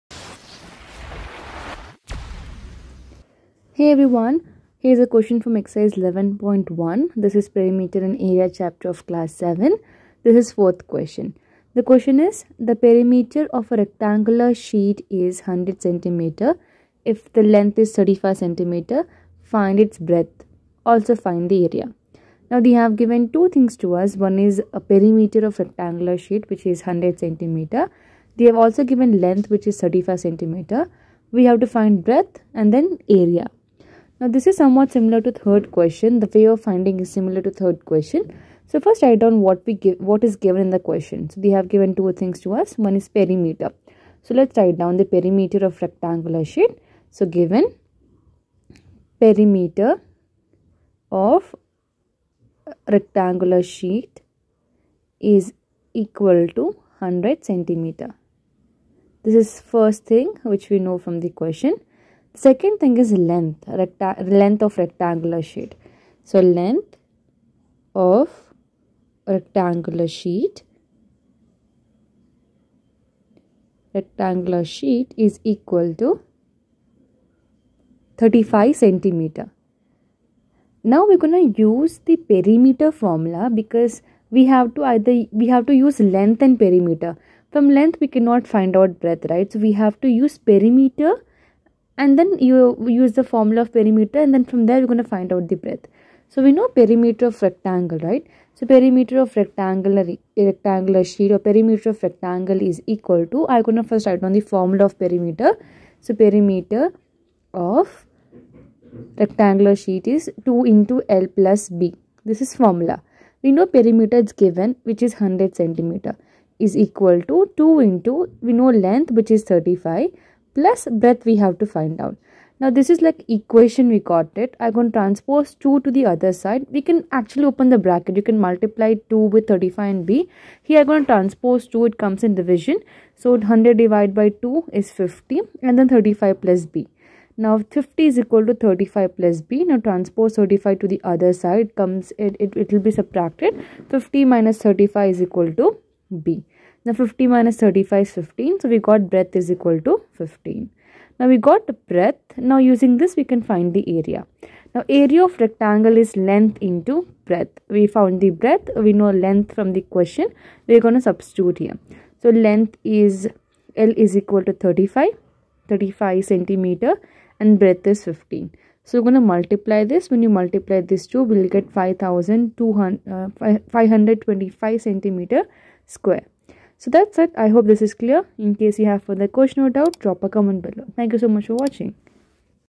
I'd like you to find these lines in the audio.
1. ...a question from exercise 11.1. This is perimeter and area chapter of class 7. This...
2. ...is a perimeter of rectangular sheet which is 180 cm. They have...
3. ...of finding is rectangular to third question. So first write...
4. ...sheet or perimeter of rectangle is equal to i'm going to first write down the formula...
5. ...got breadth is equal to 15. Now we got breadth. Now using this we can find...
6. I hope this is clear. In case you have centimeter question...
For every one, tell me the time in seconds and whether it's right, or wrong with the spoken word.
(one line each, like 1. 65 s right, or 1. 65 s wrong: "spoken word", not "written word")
1. 4 s right
2. 24 s wrong: "100", not "180"
3. 36 s wrong: "similar", not "rectangular"
4. 101 s right
5. 148 s right
6. 177 s wrong: "further", not "centimeter".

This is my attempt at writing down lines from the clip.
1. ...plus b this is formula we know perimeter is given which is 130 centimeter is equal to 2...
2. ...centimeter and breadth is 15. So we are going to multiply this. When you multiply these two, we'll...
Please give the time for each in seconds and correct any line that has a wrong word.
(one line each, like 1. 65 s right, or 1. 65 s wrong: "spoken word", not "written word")
1. 111 s wrong: "100", not "130"
2. 166 s right.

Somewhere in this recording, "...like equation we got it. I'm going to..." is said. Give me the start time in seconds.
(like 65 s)
123 s.